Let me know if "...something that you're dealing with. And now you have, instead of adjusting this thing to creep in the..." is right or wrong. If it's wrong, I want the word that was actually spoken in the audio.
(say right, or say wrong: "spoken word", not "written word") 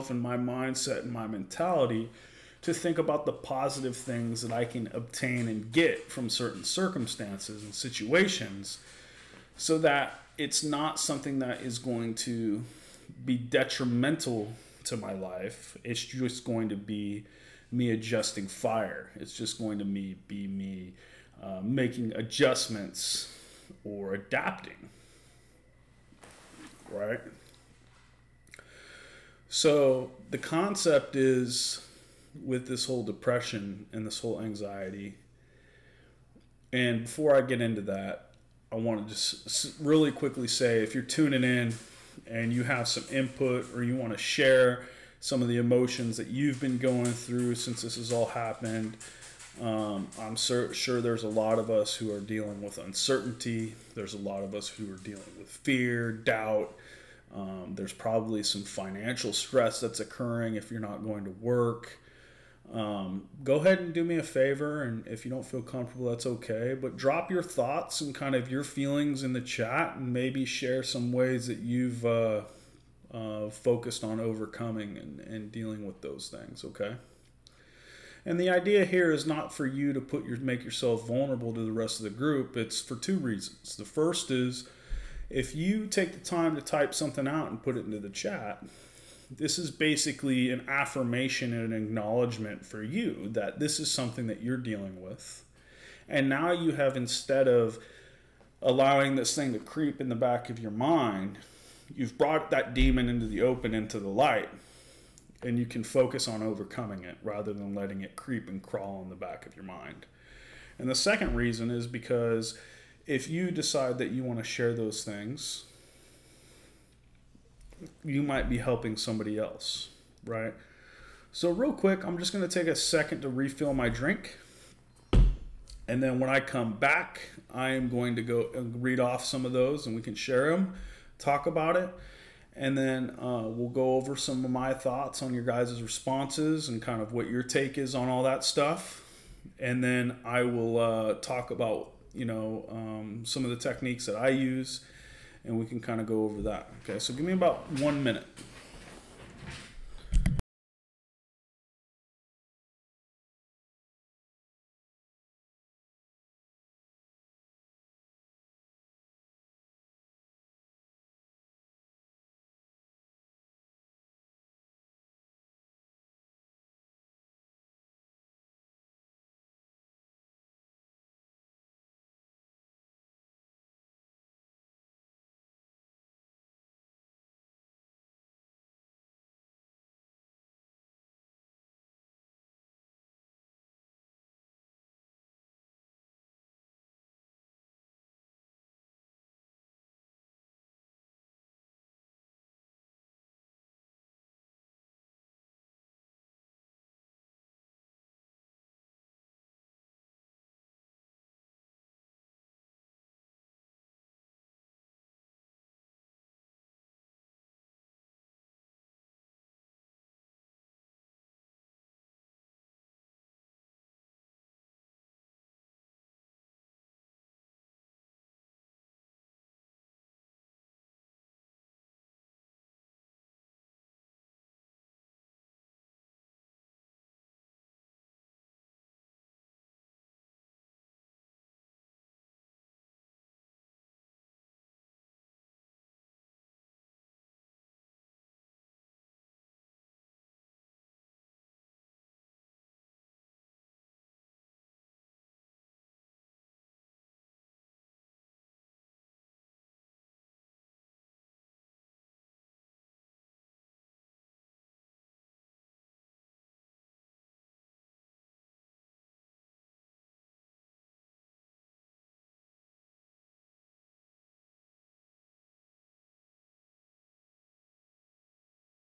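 wrong: "allowing", not "adjusting".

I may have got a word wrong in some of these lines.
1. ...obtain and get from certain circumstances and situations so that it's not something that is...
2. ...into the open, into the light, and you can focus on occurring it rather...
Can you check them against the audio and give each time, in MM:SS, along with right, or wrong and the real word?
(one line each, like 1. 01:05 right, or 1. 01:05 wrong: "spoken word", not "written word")
1. 00:04 right
2. 01:43 wrong: "overcoming", not "occurring".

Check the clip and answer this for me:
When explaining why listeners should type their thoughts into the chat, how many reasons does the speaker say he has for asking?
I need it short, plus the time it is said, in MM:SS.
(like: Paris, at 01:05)
2, at 01:22.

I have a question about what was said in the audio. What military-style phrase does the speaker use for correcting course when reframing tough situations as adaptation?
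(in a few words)
adjusting fire.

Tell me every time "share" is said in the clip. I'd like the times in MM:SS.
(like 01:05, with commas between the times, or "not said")
00:44, 01:10, 01:54, 02:10.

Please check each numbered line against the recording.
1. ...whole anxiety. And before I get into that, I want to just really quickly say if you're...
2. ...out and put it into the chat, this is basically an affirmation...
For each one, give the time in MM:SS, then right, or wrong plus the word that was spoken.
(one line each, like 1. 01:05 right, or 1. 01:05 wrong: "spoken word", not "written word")
1. 00:34 right
2. 01:27 right.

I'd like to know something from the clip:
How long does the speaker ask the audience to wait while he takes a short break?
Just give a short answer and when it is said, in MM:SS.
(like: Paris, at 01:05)
1 minute, at 02:27.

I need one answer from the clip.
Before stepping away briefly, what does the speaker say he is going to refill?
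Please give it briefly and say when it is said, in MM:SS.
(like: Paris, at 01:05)
drink, at 02:03.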